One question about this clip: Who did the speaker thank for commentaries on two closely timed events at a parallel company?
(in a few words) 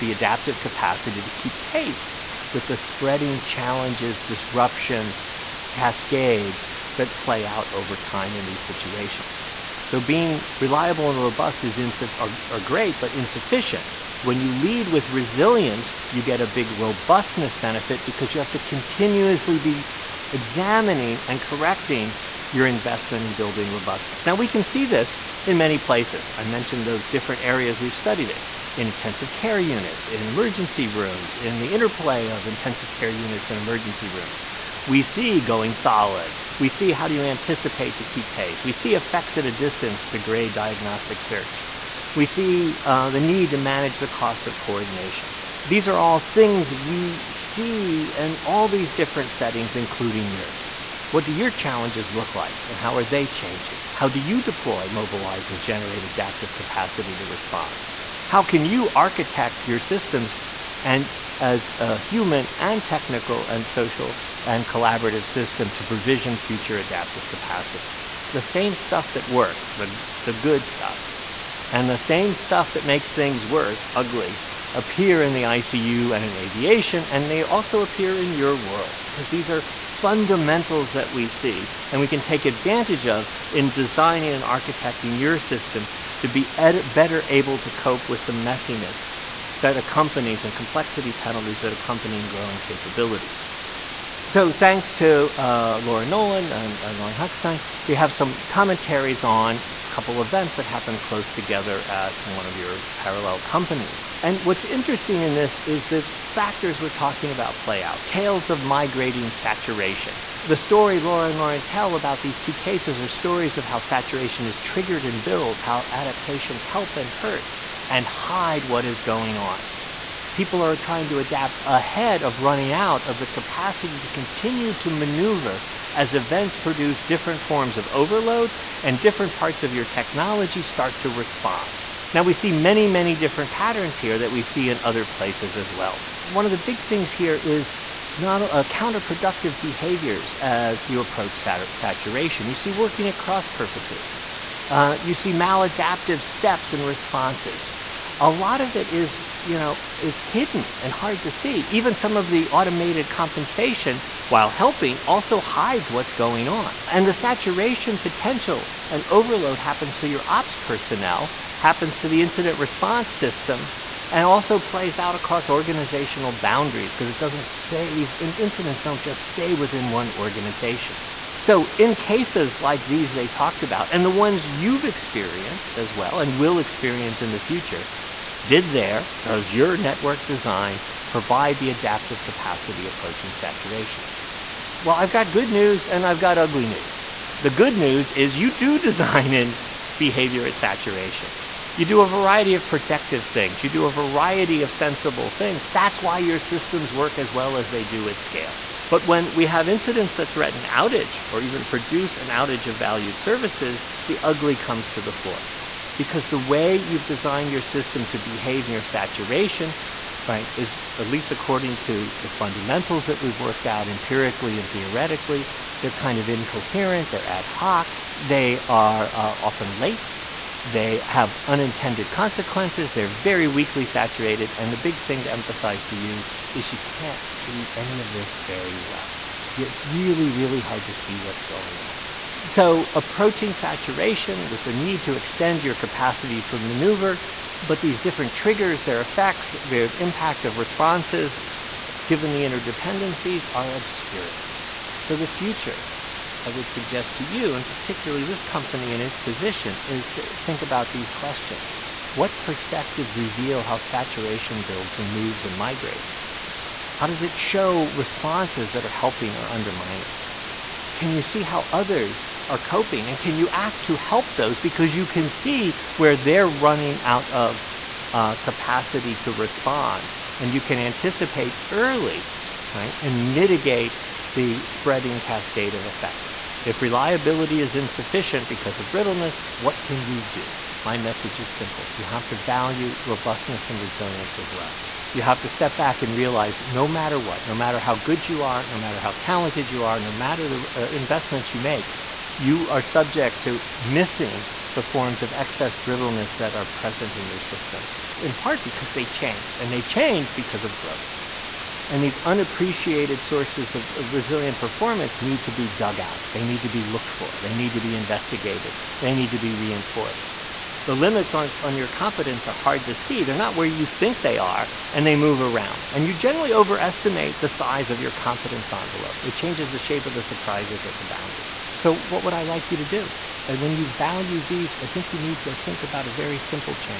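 Laura Nolan.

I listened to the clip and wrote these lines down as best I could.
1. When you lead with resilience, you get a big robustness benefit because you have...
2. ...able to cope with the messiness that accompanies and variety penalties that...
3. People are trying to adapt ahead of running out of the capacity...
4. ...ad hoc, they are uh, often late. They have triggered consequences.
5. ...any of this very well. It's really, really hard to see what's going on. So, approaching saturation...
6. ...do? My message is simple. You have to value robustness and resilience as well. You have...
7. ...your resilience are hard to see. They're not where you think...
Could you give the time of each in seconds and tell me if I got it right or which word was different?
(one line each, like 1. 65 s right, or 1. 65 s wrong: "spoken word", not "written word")
1. 14 s right
2. 87 s wrong: "complexity", not "variety"
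3. 120 s right
4. 217 s wrong: "unintended", not "triggered"
5. 227 s right
6. 280 s right
7. 311 s wrong: "competence", not "resilience".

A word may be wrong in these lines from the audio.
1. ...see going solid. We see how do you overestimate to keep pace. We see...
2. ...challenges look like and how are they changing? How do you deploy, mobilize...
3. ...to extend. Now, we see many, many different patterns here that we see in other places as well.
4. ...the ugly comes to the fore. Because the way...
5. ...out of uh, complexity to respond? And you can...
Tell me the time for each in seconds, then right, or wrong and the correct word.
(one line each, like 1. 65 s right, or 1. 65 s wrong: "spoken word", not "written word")
1. 35 s wrong: "anticipate", not "overestimate"
2. 51 s right
3. 131 s wrong: "respond", not "extend"
4. 204 s right
5. 267 s wrong: "capacity", not "complexity".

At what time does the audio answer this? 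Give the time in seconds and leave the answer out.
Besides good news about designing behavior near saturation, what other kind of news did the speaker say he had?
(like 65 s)
186 s.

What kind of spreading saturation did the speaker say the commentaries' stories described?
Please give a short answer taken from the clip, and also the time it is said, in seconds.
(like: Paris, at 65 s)
migrating saturation, at 108 s.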